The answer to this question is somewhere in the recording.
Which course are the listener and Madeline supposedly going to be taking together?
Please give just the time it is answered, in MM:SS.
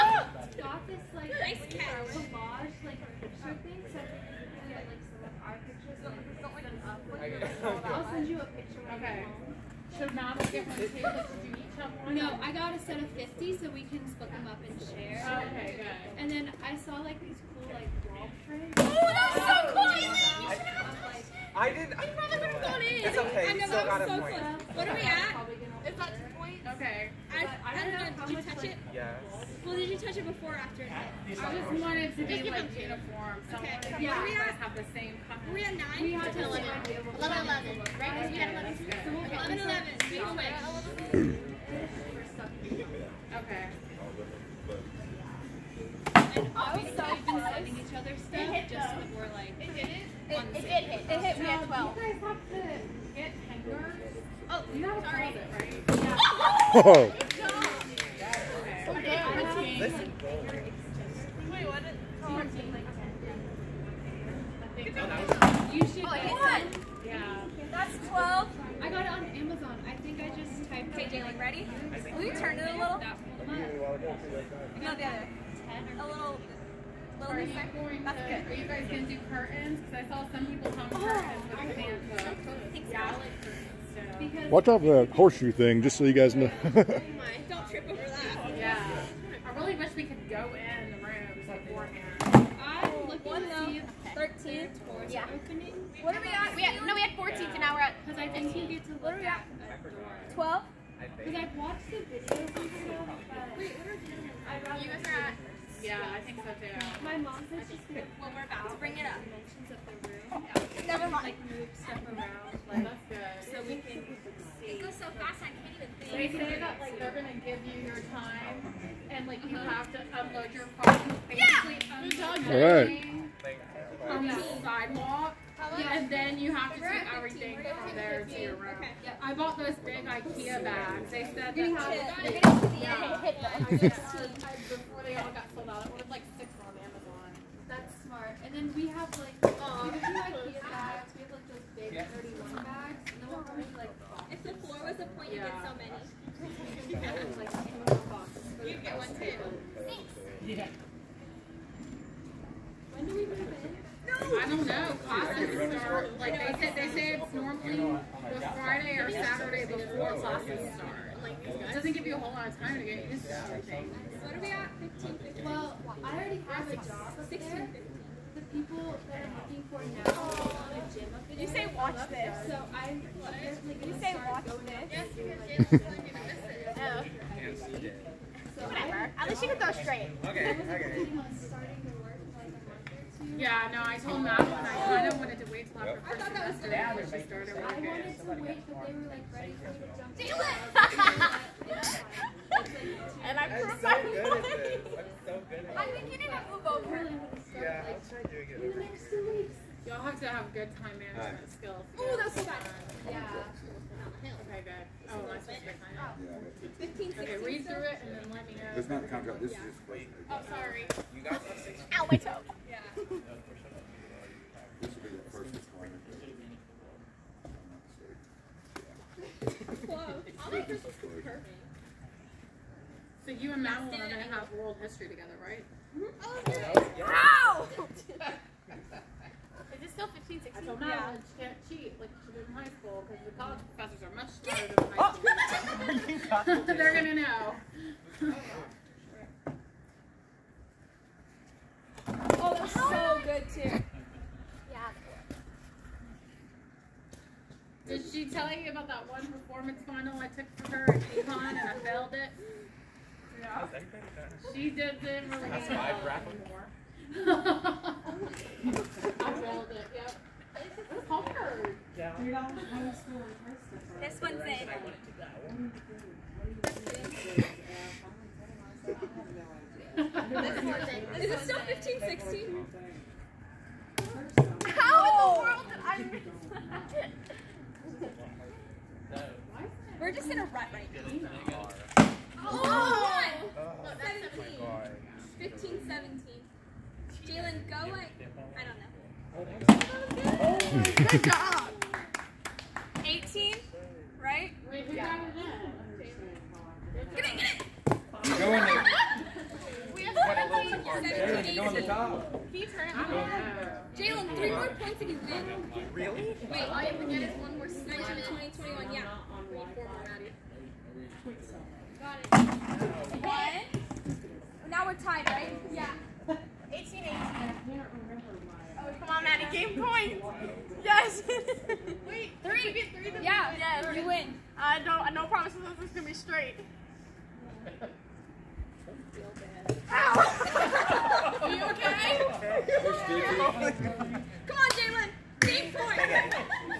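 03:44.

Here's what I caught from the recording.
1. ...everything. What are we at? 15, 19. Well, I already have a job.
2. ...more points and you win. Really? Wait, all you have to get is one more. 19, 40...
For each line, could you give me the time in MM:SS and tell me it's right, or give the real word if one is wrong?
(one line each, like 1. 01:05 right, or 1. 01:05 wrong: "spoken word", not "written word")
1. 02:43 wrong: "15", not "19"
2. 05:04 wrong: "20", not "40".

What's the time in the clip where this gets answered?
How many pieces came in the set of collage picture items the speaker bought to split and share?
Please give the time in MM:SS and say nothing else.
00:12.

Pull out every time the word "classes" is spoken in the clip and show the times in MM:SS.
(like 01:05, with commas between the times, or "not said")
02:35, 02:40.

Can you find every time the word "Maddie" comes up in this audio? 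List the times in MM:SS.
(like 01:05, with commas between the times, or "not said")
05:10, 05:19.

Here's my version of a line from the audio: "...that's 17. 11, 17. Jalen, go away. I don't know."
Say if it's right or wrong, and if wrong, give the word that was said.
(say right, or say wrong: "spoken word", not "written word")
wrong: "15", not "11".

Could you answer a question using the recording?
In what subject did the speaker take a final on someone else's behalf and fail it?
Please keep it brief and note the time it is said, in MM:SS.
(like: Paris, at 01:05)
Econ, at 04:11.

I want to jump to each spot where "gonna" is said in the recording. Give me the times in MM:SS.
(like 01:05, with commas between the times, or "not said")
01:57, 05:25.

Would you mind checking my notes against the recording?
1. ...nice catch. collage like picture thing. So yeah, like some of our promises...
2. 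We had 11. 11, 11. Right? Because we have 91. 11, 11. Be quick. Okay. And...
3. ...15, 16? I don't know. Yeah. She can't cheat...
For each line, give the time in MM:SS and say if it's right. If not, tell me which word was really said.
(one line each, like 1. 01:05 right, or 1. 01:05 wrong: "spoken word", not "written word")
1. 00:01 wrong: "pictures", not "promises"
2. 00:36 wrong: "11", not "91"
3. 03:50 right.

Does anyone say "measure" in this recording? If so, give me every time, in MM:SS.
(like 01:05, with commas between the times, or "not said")
not said.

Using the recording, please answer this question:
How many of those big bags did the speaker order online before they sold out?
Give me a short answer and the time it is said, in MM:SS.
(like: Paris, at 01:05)
6, at 02:16.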